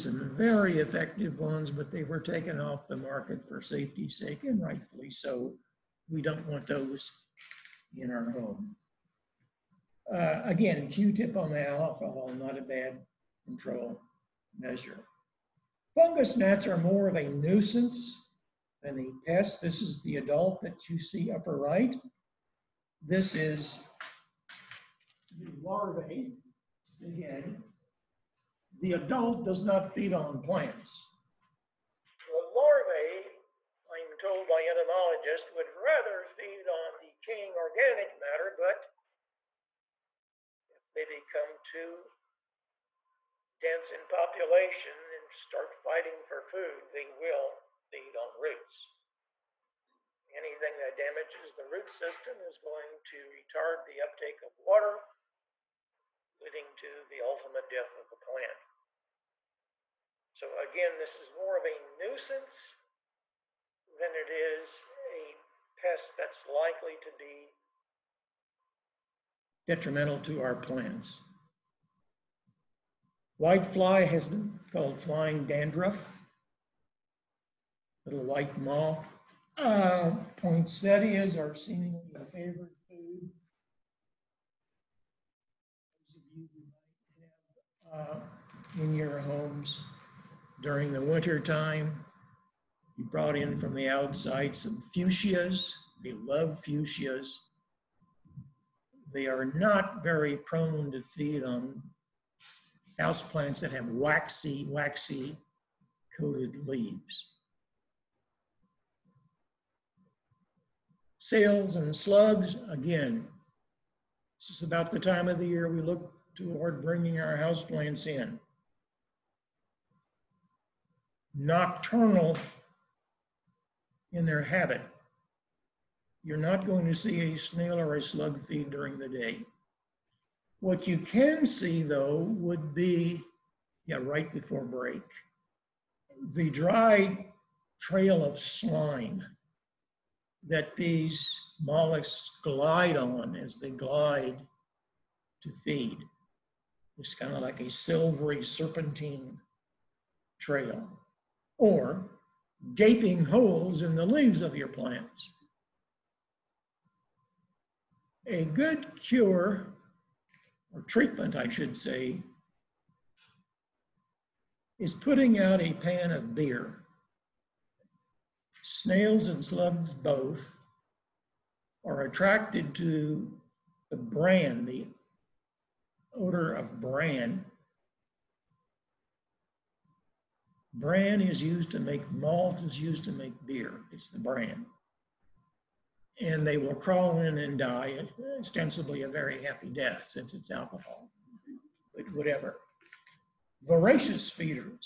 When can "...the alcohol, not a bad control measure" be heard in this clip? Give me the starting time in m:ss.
0:11.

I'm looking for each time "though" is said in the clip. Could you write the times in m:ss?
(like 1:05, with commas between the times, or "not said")
2:11.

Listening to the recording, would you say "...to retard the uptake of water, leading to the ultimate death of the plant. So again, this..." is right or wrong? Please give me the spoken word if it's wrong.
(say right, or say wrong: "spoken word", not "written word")
right.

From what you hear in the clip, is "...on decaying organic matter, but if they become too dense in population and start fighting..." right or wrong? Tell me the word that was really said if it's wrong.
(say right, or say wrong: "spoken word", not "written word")
right.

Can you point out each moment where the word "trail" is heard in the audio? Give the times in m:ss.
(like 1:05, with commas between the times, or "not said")
2:17, 2:30.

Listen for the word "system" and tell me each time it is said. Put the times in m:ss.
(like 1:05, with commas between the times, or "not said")
0:51.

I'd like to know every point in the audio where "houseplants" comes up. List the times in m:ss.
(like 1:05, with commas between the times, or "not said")
1:43, 1:57.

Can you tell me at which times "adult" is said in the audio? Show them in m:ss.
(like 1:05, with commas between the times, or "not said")
0:20, 0:28.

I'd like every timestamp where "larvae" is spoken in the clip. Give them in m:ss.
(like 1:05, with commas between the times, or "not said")
0:25, 0:32.